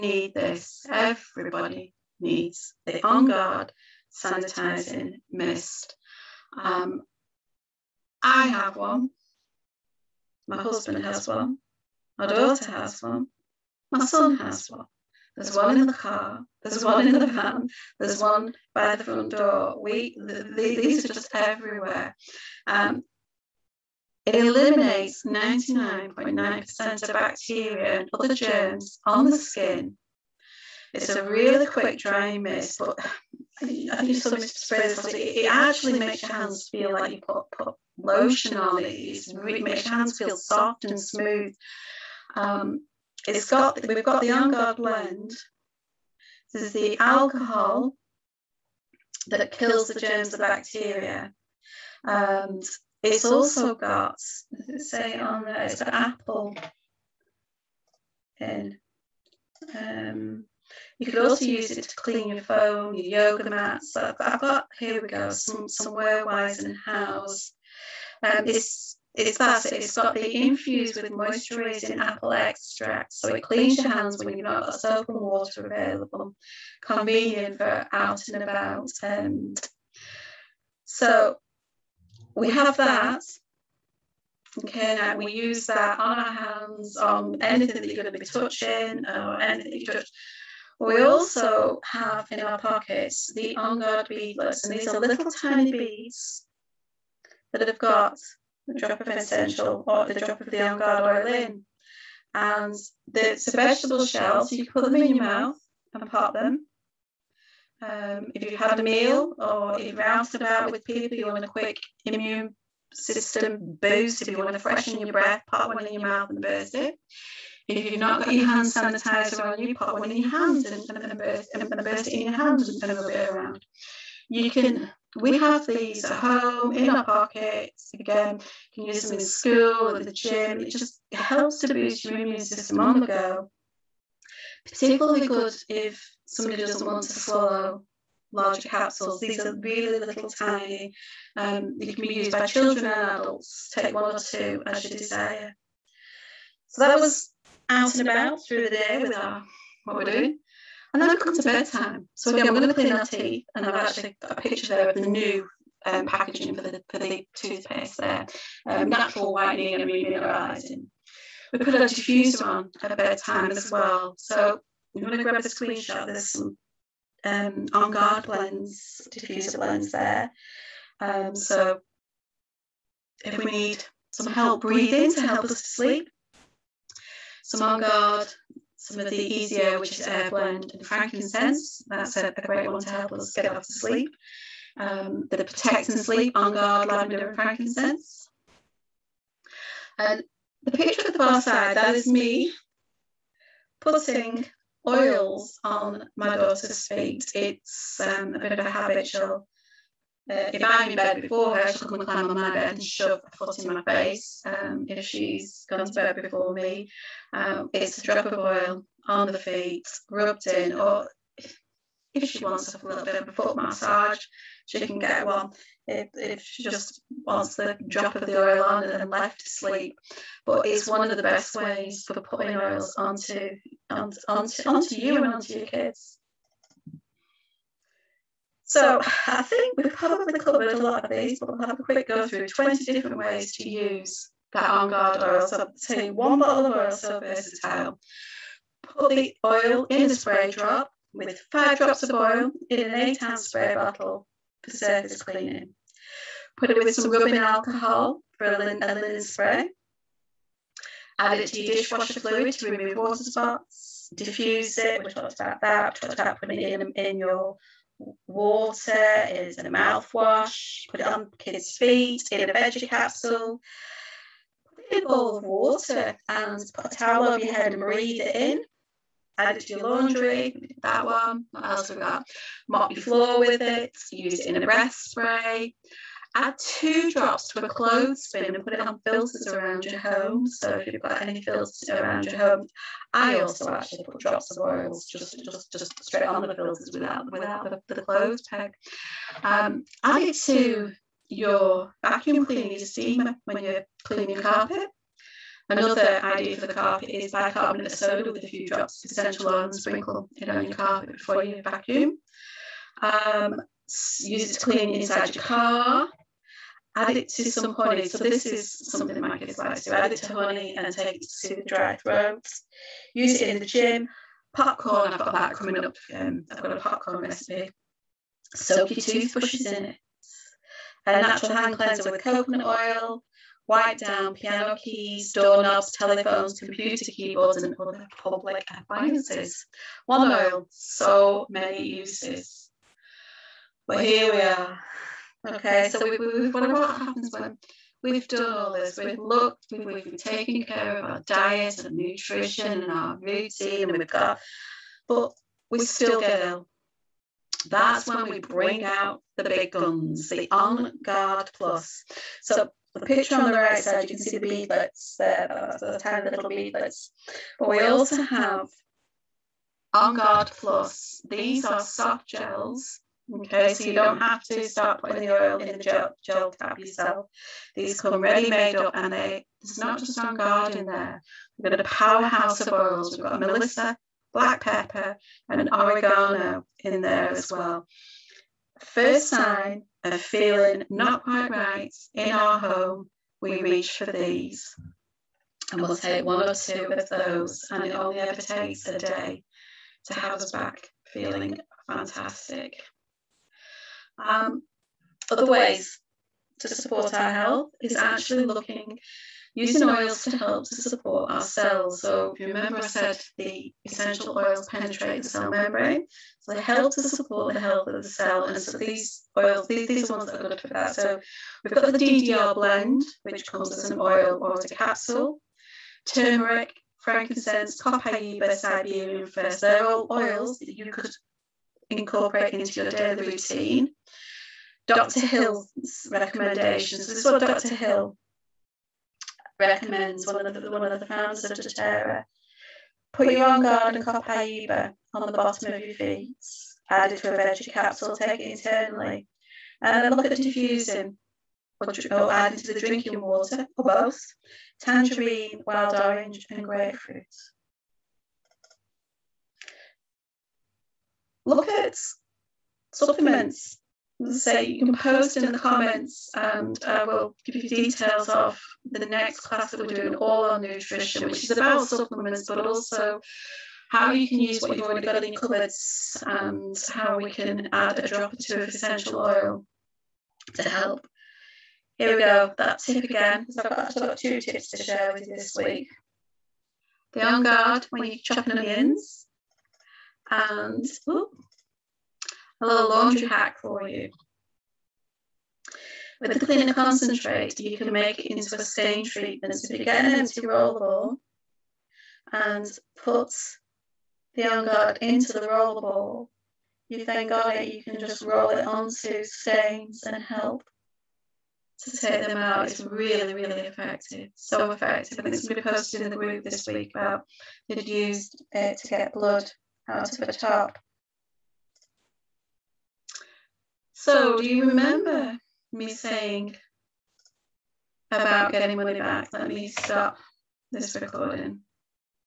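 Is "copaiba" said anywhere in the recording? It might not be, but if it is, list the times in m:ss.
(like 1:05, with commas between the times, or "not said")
6:57, 7:14.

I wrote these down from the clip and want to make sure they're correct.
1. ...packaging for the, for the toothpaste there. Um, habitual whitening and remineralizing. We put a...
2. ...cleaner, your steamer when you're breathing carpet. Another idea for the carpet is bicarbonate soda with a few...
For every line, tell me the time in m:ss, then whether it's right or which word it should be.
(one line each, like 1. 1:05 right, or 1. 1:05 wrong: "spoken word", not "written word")
1. 2:36 wrong: "natural", not "habitual"
2. 4:52 wrong: "cleaning", not "breathing".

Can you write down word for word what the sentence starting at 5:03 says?
Um, use it to clean inside your car.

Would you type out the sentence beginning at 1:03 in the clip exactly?
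I've, got, here we go, some, some wear-wise and house.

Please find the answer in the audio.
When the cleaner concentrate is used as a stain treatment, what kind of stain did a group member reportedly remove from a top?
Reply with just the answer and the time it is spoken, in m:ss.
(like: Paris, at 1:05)
Blood, at 8:29.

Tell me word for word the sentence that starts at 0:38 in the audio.
It makes your hands feel soft and smooth.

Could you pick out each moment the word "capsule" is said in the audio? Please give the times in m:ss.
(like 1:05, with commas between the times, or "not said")
2:18, 4:22, 6:54, 7:17.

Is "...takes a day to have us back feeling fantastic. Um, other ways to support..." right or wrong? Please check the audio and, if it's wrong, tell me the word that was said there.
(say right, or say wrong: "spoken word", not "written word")
right.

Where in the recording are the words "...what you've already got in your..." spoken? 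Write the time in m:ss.
7:44.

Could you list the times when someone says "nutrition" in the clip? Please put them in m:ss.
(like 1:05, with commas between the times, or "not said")
5:41, 7:40.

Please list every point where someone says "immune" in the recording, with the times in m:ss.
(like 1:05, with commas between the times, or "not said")
1:52, 2:12.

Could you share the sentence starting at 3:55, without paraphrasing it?
So take one bottle of oil so versatile.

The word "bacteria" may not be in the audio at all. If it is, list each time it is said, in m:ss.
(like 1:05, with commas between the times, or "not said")
0:27, 0:50.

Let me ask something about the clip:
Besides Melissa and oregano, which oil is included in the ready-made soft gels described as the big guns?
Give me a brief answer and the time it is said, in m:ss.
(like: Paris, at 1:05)
Black pepper, at 6:14.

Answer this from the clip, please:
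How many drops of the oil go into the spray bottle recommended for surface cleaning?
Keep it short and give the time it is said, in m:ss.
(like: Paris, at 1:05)
5, at 4:01.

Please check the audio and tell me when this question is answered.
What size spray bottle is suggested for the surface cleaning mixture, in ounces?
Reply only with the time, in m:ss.
4:02.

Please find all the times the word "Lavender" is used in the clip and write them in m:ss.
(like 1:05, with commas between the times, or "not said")
3:06.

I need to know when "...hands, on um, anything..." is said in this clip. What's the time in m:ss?
1:26.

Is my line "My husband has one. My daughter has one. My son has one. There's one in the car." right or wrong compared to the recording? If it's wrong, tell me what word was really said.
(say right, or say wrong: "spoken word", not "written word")
right.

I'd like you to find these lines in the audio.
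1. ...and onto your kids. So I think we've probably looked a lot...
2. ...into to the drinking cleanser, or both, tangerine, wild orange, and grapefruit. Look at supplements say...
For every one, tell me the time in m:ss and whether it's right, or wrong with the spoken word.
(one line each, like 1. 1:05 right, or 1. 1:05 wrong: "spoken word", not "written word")
1. 3:45 wrong: "covered", not "looked"
2. 7:22 wrong: "water", not "cleanser".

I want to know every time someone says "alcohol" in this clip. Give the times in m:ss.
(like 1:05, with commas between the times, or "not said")
0:46, 4:07.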